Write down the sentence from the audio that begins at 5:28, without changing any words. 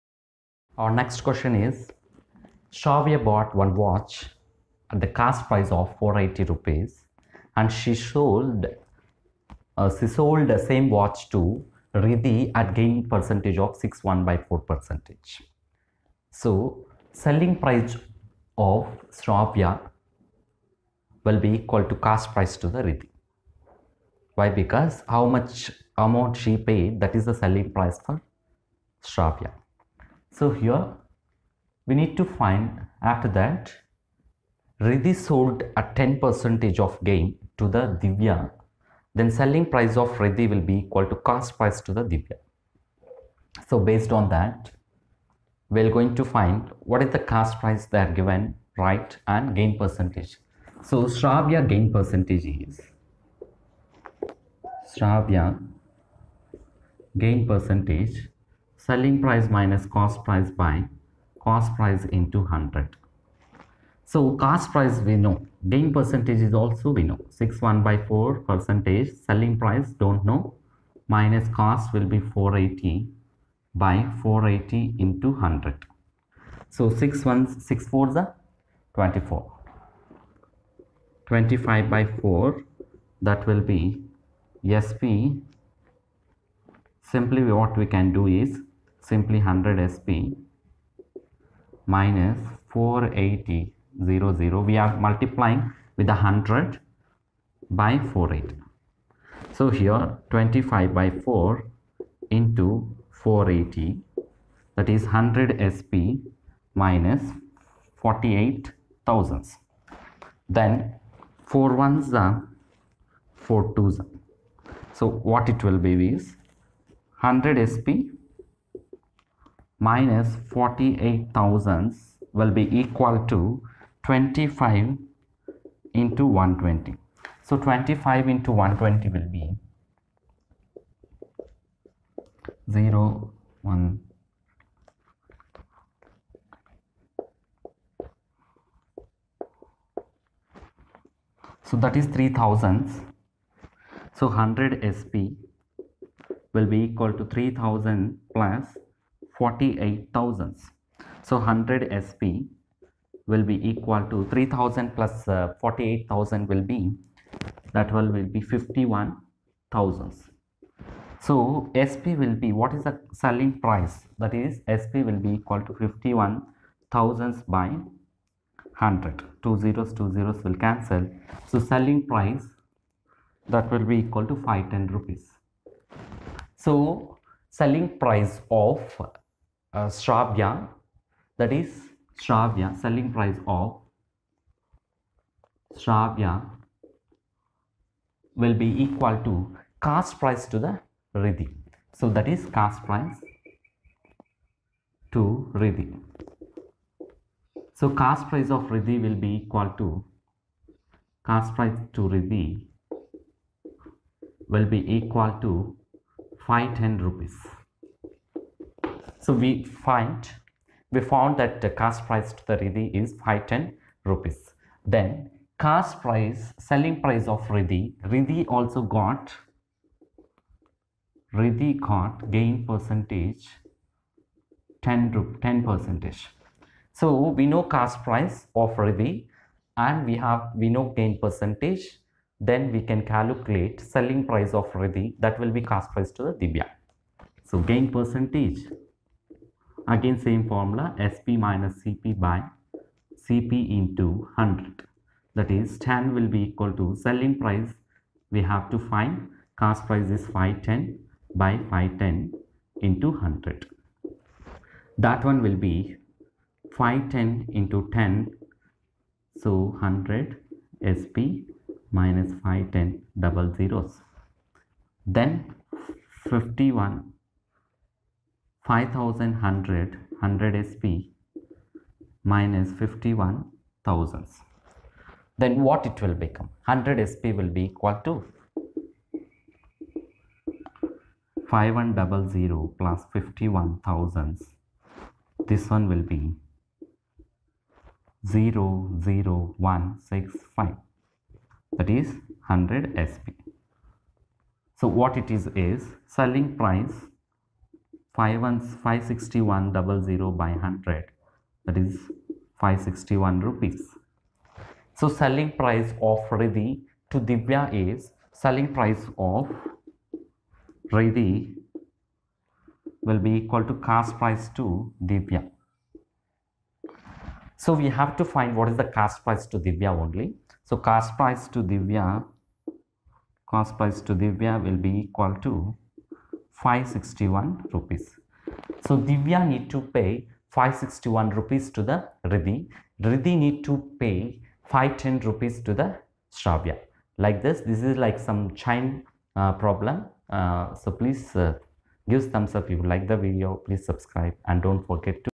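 So Divya need to pay 561 rupees to the Riddhi.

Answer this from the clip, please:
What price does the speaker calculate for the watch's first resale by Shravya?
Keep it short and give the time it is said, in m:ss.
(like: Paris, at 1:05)
510 rupees, at 2:53.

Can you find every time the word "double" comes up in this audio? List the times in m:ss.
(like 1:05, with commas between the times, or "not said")
4:23, 4:59.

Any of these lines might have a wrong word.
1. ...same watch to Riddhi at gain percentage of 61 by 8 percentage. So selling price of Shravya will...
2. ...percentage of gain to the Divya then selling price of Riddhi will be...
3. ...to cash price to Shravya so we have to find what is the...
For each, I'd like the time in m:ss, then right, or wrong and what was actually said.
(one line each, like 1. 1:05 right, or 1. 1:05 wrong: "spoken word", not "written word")
1. 0:10 wrong: "4", not "8"
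2. 0:36 right
3. 5:13 wrong: "Divya", not "Shravya".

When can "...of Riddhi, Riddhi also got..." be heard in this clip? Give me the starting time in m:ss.
3:37.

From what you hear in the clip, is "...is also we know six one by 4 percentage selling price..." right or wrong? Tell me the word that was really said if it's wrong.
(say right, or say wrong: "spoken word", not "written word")
right.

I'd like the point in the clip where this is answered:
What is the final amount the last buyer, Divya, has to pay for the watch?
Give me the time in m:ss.
5:23.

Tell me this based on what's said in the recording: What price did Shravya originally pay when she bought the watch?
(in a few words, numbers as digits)
480 rupees.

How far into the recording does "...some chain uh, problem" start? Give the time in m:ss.
5:38.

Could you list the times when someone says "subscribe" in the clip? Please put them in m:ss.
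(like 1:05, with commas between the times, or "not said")
5:43.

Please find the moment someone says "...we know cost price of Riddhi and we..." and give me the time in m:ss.
3:47.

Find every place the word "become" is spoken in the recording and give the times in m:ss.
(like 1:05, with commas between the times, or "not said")
4:36.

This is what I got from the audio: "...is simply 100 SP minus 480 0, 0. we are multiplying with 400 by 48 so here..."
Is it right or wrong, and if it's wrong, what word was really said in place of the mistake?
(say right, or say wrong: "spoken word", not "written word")
wrong: "100", not "400".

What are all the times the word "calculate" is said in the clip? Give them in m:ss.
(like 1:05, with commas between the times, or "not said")
3:53.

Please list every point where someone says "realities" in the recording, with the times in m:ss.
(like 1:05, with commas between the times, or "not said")
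not said.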